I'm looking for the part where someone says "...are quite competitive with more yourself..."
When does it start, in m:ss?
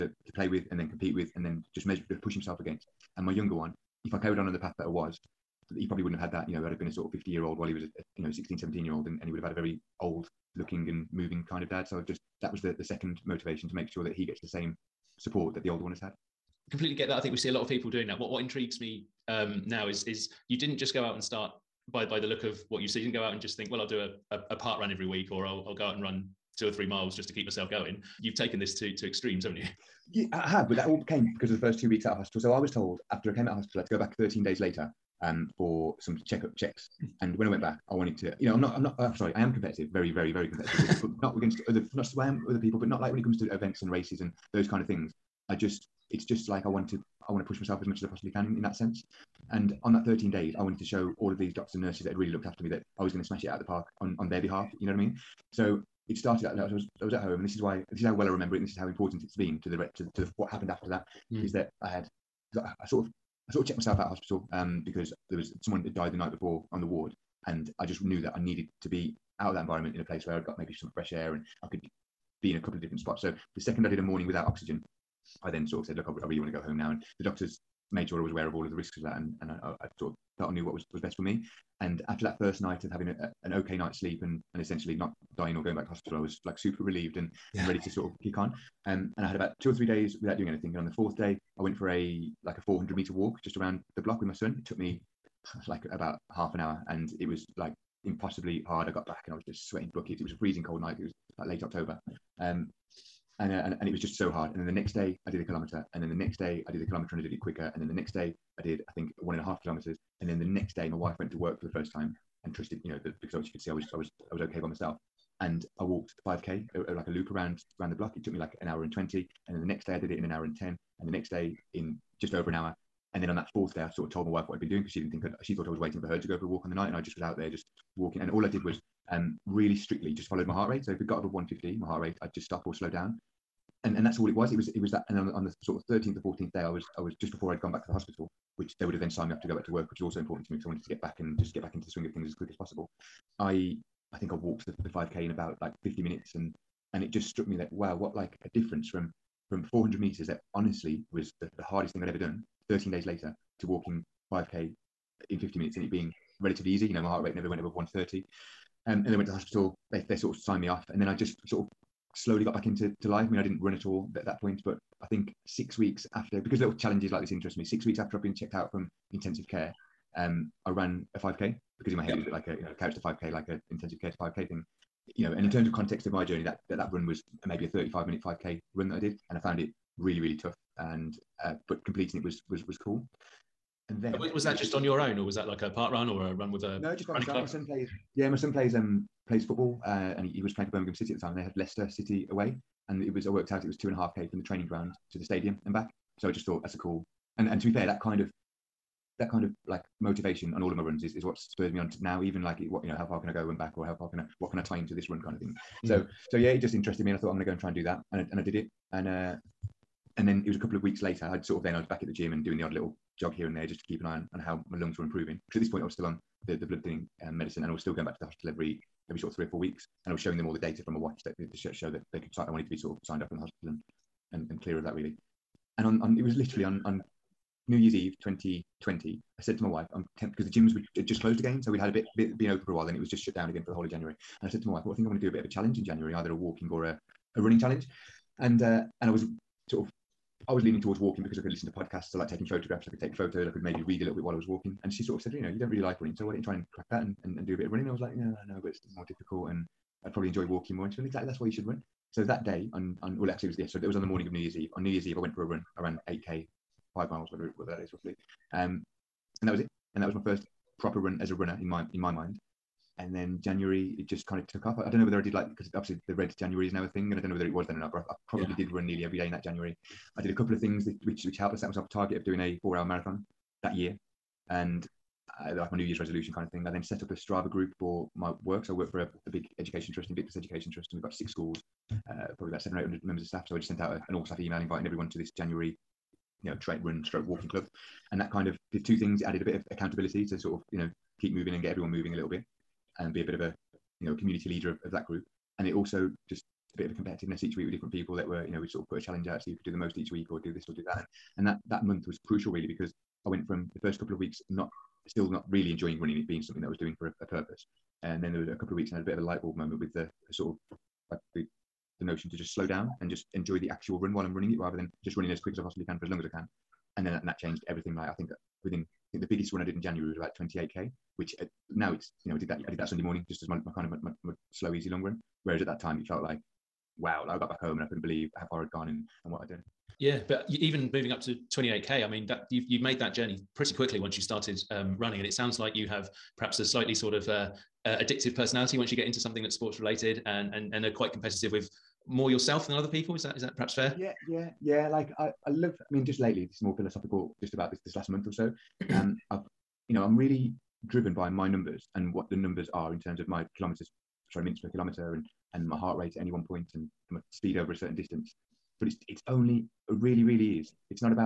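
5:40.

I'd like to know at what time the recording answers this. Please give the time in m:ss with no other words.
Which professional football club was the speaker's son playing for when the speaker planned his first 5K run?
3:10.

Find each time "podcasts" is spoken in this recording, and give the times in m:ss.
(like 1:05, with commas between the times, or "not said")
4:01.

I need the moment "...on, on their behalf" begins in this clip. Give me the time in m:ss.
0:54.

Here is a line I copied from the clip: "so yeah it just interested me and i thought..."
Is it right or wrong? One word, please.
right.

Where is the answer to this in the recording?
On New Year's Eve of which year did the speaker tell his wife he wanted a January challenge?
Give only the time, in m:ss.
3:48.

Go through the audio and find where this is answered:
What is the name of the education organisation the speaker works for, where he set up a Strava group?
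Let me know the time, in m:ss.
4:40.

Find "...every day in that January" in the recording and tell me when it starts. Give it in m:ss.
4:29.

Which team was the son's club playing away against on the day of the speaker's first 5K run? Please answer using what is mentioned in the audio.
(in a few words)
Leicester City.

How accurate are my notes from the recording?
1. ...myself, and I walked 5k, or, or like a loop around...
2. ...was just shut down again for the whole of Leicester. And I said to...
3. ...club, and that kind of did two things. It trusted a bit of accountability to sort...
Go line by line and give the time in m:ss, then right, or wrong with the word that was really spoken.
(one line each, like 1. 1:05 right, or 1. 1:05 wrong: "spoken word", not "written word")
1. 1:54 right
2. 3:52 wrong: "January", not "Leicester"
3. 4:47 wrong: "added", not "trusted".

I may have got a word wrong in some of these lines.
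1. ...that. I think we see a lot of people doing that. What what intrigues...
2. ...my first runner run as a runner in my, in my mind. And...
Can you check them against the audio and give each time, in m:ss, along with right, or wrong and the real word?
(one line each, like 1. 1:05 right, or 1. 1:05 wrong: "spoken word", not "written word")
1. 0:17 right
2. 4:20 wrong: "proper", not "runner".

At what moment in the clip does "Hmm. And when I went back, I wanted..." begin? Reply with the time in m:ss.
0:37.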